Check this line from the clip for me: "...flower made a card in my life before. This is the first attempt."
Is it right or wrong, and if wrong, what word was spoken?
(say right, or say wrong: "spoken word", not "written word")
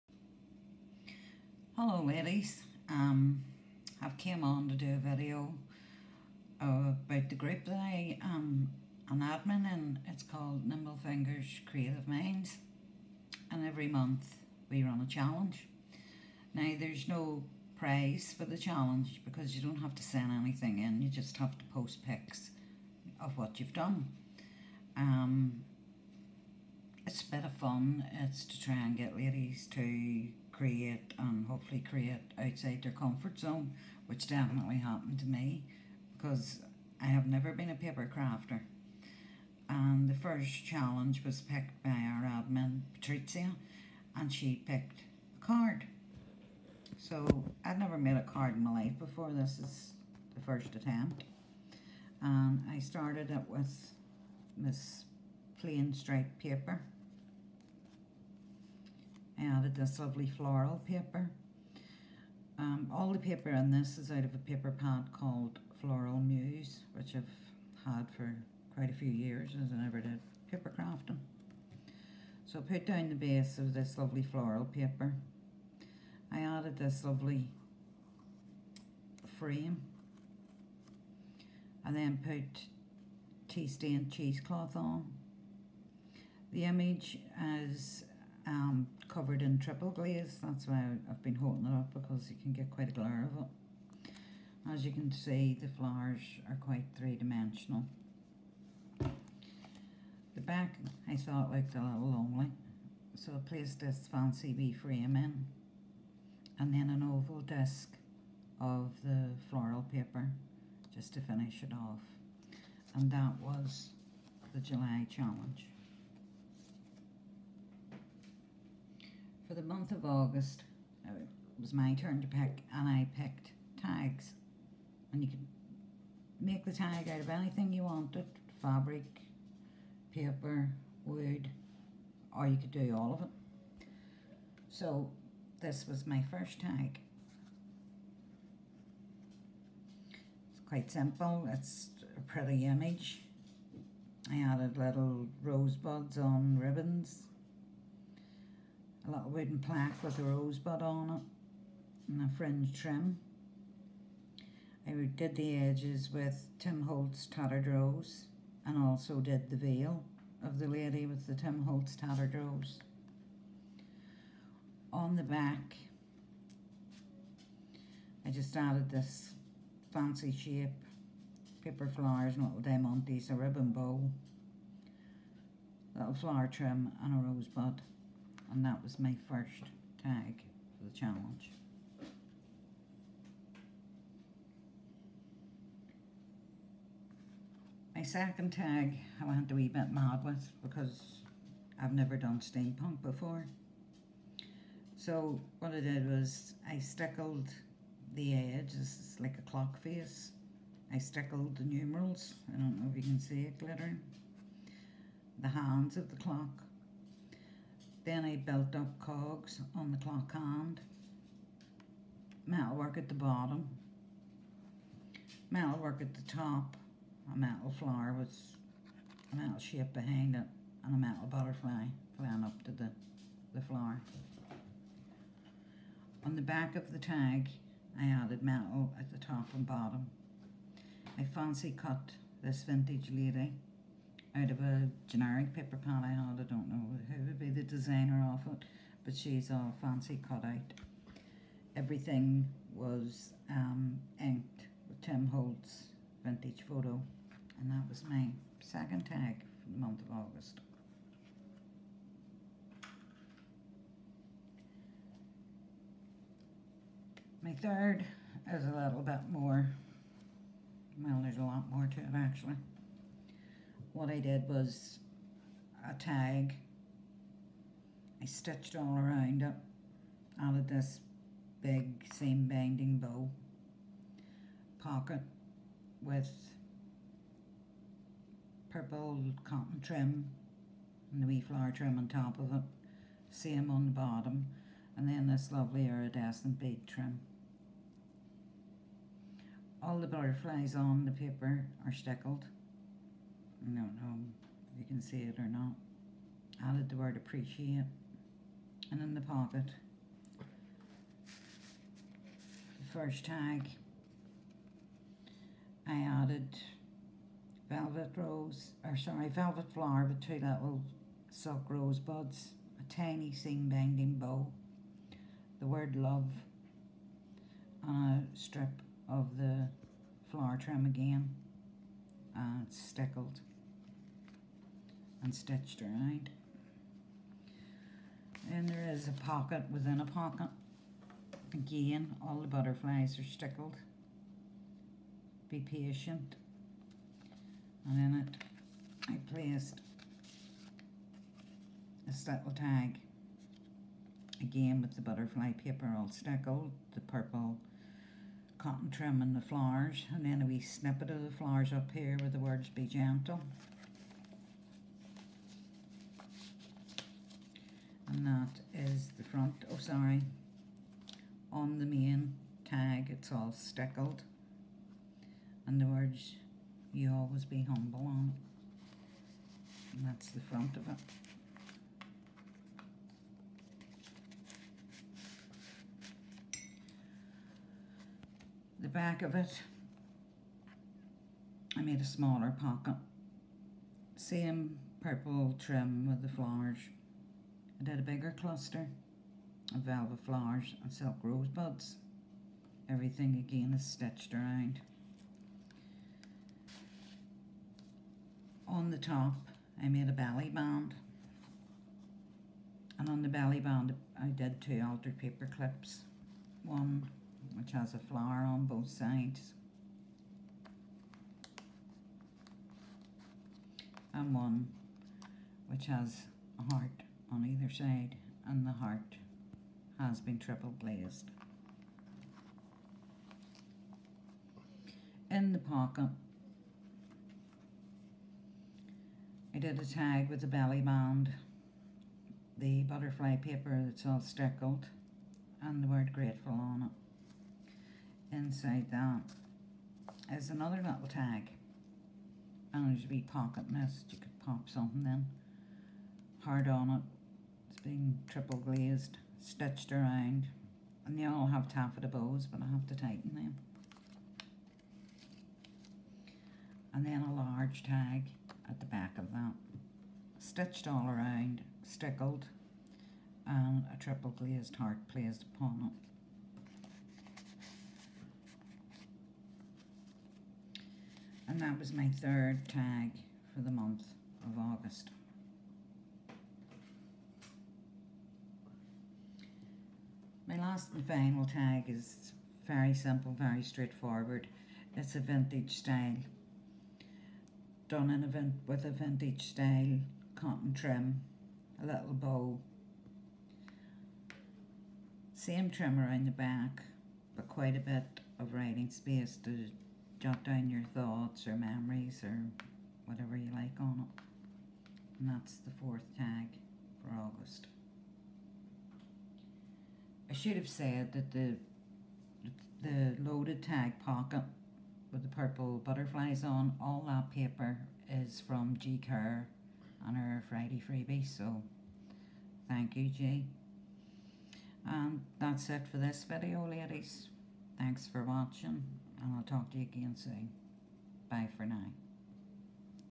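wrong: "never", not "flower".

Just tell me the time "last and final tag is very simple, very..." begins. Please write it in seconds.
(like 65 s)
480 s.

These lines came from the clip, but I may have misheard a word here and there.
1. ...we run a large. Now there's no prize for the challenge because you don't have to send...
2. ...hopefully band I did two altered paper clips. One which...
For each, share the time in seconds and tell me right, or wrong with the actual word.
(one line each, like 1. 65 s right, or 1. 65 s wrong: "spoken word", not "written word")
1. 14 s wrong: "challenge", not "large"
2. 403 s wrong: "belly", not "hopefully".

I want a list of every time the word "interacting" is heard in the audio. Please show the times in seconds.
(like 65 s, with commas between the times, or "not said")
not said.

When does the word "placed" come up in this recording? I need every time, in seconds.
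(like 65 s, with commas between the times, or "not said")
103 s, 339 s, 465 s.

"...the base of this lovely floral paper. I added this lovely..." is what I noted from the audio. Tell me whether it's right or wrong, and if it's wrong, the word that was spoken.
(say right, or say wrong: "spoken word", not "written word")
right.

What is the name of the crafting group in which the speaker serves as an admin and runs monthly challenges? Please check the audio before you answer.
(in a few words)
Nimble Fingers Creative Minds.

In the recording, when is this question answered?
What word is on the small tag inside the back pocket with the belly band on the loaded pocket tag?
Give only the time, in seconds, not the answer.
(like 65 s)
436 s.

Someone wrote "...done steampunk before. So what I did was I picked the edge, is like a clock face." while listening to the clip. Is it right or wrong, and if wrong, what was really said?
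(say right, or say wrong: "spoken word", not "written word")
wrong: "stickled", not "picked".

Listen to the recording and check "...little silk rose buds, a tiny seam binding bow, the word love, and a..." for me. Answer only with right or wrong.
right.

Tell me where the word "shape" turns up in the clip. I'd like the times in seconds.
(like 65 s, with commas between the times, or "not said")
170 s, 219 s.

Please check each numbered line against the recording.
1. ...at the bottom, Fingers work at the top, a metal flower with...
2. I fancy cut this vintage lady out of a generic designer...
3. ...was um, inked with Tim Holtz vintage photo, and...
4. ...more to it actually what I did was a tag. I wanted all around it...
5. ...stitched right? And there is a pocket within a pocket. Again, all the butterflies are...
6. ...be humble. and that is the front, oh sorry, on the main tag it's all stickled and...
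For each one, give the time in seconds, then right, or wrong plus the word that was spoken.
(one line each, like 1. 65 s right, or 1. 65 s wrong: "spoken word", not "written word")
1. 212 s wrong: "Metalwork", not "Fingers"
2. 231 s wrong: "paper", not "designer"
3. 242 s right
4. 261 s wrong: "stitched", not "wanted"
5. 325 s right
6. 352 s wrong: "gentle", not "humble".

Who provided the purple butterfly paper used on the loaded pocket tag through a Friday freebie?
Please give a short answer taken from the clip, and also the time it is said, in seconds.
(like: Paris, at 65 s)
G Kerr, at 518 s.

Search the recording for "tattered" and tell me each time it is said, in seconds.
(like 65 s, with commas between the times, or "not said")
157 s, 161 s.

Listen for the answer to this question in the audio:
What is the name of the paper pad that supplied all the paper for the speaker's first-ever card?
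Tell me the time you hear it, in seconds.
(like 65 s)
65 s.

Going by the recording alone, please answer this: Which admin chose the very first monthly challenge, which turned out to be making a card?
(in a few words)
Patrizia.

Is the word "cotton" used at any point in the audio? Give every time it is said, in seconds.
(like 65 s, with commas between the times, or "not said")
279 s, 348 s, 490 s.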